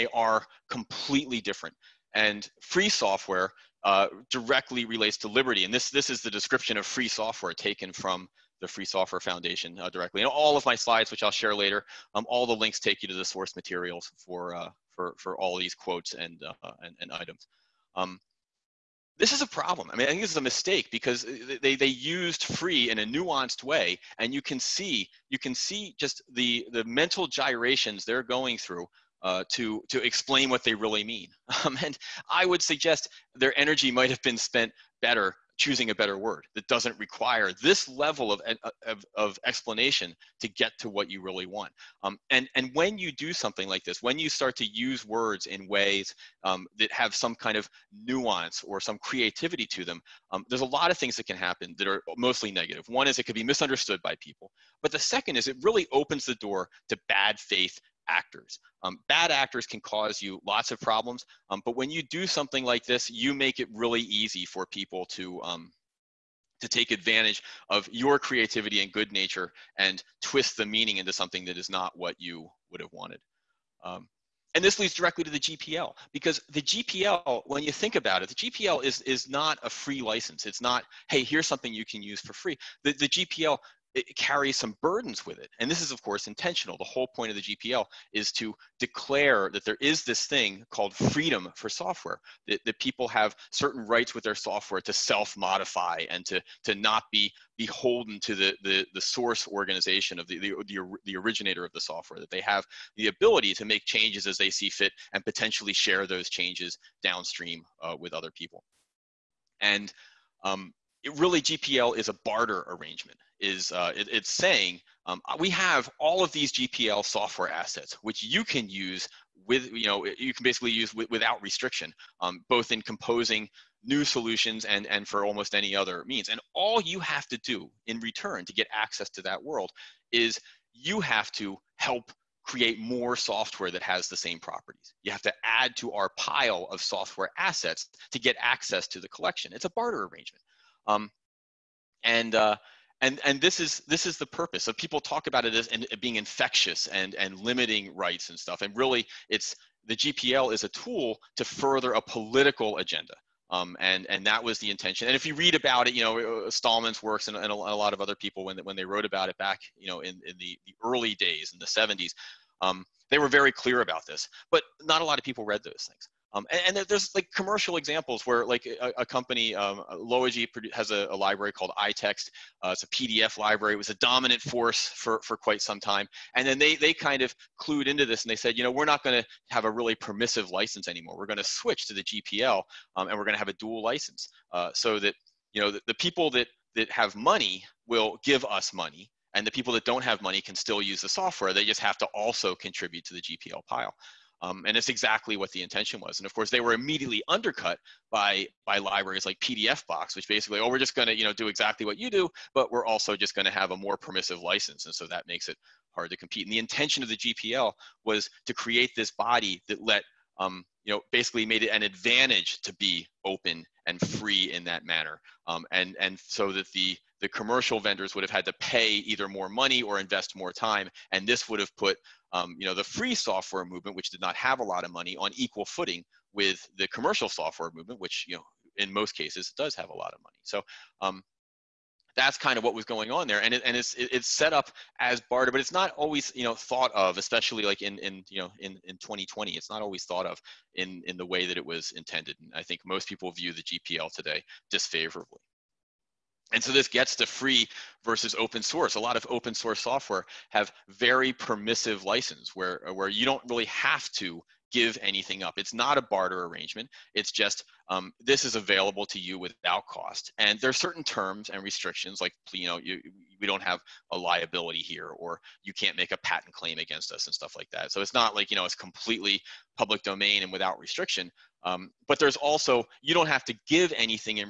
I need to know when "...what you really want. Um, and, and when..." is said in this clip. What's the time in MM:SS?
00:40.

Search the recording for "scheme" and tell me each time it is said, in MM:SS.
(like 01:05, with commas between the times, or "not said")
not said.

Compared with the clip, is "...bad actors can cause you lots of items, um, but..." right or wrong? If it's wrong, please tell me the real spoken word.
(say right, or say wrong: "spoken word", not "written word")
wrong: "problems", not "items".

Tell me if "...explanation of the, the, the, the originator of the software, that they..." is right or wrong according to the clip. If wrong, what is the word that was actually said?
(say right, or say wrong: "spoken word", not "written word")
wrong: "organization", not "explanation".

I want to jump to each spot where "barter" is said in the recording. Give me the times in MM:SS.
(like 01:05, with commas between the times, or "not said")
01:52, 02:19, 03:55, 04:16.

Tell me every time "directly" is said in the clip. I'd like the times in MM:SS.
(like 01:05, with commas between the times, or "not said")
00:04, 00:09, 01:14.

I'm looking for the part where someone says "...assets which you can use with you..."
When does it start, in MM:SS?
01:57.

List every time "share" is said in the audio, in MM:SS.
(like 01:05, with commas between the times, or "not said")
00:11, 01:45.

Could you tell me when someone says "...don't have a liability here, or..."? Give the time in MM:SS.
04:23.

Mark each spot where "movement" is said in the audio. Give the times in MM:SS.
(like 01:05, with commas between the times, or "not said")
03:43, 03:47.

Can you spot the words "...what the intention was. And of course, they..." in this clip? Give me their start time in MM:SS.
03:15.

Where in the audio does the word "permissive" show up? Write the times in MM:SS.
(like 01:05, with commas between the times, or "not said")
02:59, 03:23, 04:11.